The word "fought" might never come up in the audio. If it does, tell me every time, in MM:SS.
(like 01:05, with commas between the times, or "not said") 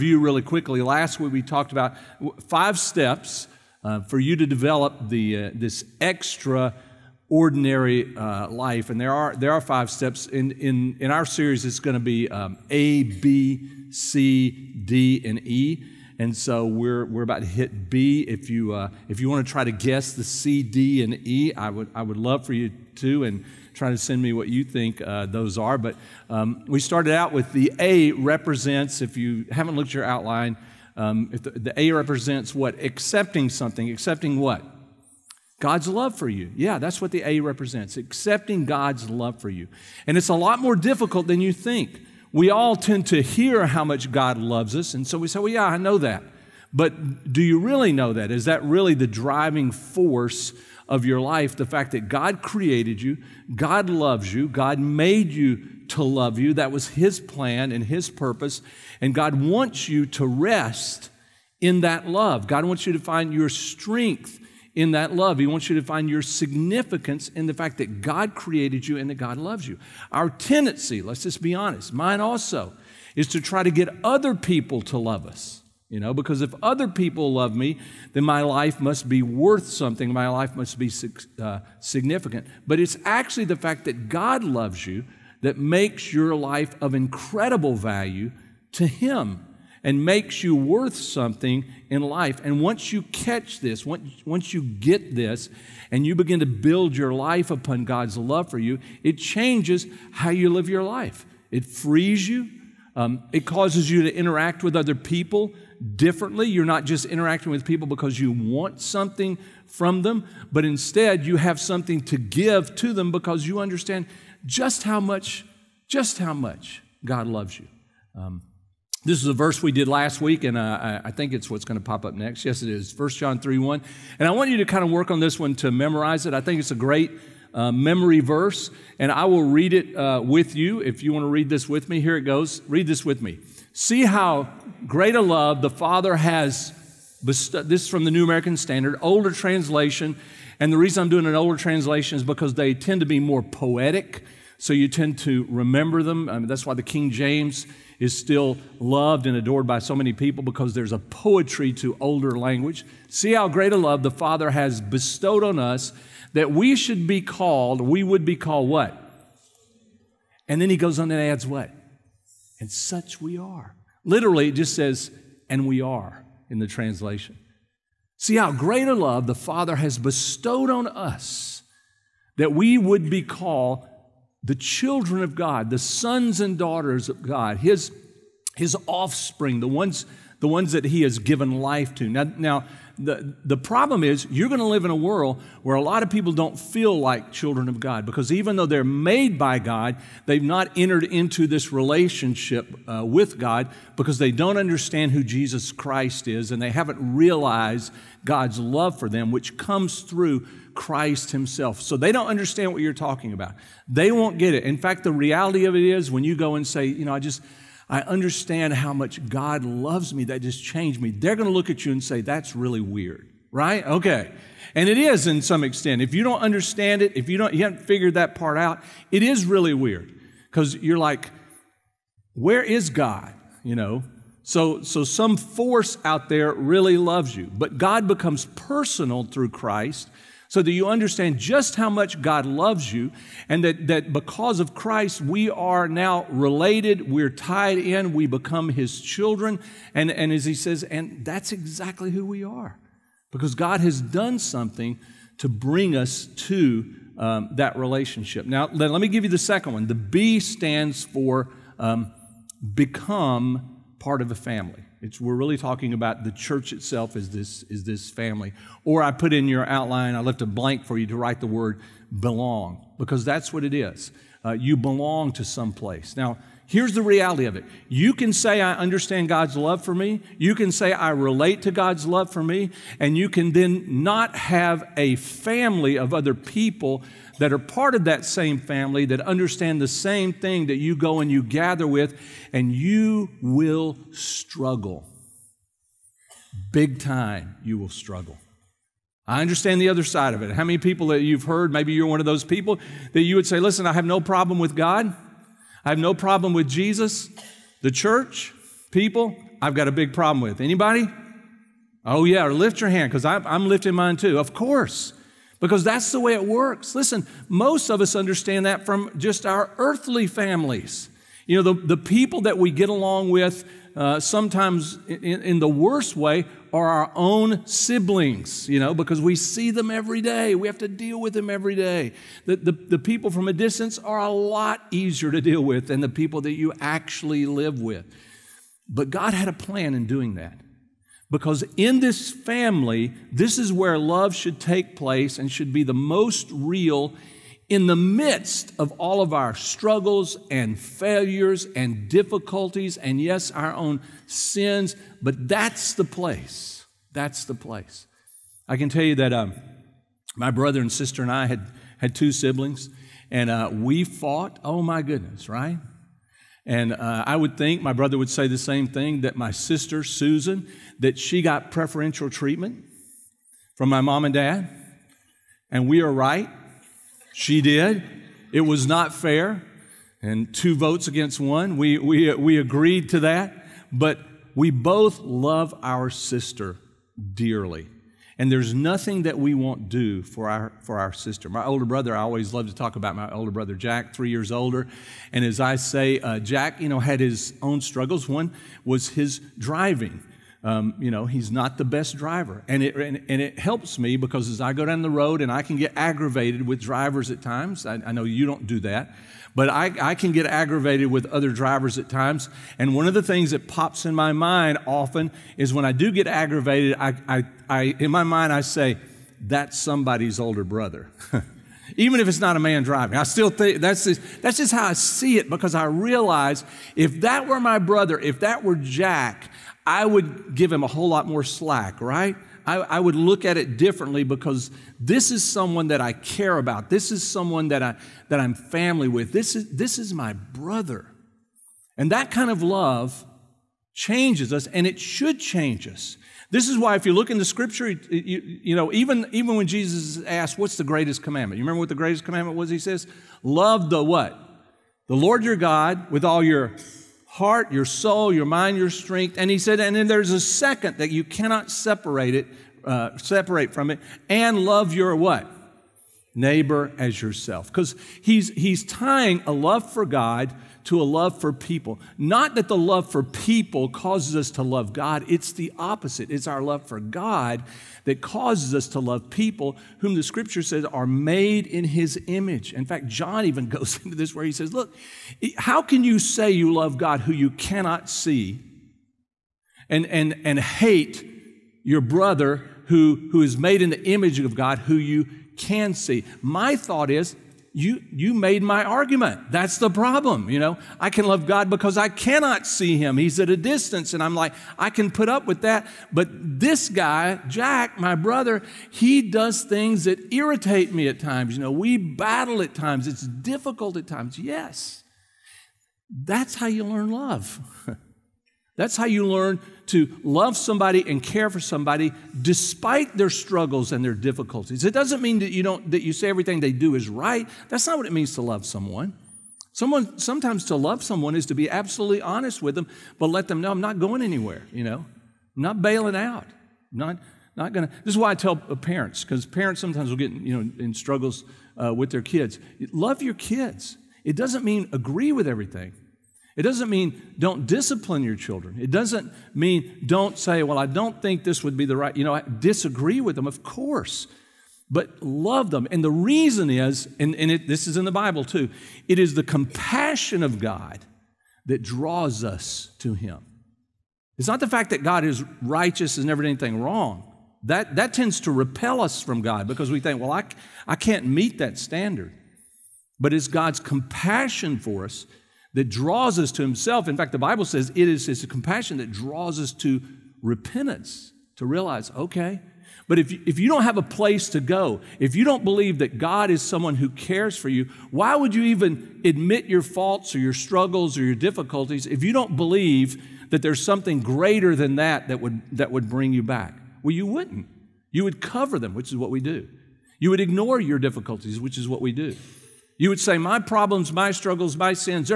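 05:54.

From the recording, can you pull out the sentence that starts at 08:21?
You know, we battle at times.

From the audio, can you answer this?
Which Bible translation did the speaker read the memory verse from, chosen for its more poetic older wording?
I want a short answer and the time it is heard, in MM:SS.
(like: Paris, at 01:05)
New American Standard, at 02:18.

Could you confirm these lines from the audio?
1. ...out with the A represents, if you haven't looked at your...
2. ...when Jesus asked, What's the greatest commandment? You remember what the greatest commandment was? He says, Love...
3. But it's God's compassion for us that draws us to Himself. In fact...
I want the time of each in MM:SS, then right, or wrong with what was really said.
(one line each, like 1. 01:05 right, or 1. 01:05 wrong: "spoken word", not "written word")
1. 00:27 right
2. 07:19 right
3. 09:23 right.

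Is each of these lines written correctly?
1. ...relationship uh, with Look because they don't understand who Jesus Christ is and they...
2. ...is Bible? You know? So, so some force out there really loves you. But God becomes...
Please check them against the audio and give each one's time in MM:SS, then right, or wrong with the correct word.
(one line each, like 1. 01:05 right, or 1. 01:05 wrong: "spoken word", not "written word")
1. 03:11 wrong: "God", not "Look"
2. 03:42 wrong: "God", not "Bible".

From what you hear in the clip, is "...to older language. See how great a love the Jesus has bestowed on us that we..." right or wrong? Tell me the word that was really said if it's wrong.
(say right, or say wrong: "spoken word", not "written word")
wrong: "Father", not "Jesus".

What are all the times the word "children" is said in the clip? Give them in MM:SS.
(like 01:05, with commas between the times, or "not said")
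02:54, 03:07, 03:58, 08:58.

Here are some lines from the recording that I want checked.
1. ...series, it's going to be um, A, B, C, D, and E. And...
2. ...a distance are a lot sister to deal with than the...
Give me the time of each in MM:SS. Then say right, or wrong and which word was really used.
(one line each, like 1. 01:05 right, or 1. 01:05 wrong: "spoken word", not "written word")
1. 00:11 right
2. 05:23 wrong: "easier", not "sister".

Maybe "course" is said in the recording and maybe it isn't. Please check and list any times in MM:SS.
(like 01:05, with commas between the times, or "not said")
05:04, 09:03.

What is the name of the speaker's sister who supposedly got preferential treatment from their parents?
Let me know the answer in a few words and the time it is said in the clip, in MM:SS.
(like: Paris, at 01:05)
Susan, at 06:00.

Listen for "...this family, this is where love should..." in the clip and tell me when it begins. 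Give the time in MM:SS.
05:32.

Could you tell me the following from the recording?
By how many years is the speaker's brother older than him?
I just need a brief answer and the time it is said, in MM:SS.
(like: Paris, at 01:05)
3, at 06:24.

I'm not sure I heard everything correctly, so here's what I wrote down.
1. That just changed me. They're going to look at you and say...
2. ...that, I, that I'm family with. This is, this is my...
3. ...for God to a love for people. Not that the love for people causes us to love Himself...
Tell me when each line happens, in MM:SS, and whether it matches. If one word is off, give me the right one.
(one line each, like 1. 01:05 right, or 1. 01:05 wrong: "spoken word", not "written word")
1. 03:30 right
2. 07:07 right
3. 07:39 wrong: "God", not "Himself".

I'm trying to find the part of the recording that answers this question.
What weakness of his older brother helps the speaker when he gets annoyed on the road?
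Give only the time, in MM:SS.
06:29.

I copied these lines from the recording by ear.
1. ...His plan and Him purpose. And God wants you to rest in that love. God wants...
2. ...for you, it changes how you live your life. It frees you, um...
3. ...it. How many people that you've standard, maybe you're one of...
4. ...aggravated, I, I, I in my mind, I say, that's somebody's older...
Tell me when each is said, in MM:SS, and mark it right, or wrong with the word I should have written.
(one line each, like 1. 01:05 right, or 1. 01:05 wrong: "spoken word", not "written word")
1. 00:56 wrong: "His", not "Him"
2. 01:38 right
3. 04:50 wrong: "heard", not "standard"
4. 06:46 right.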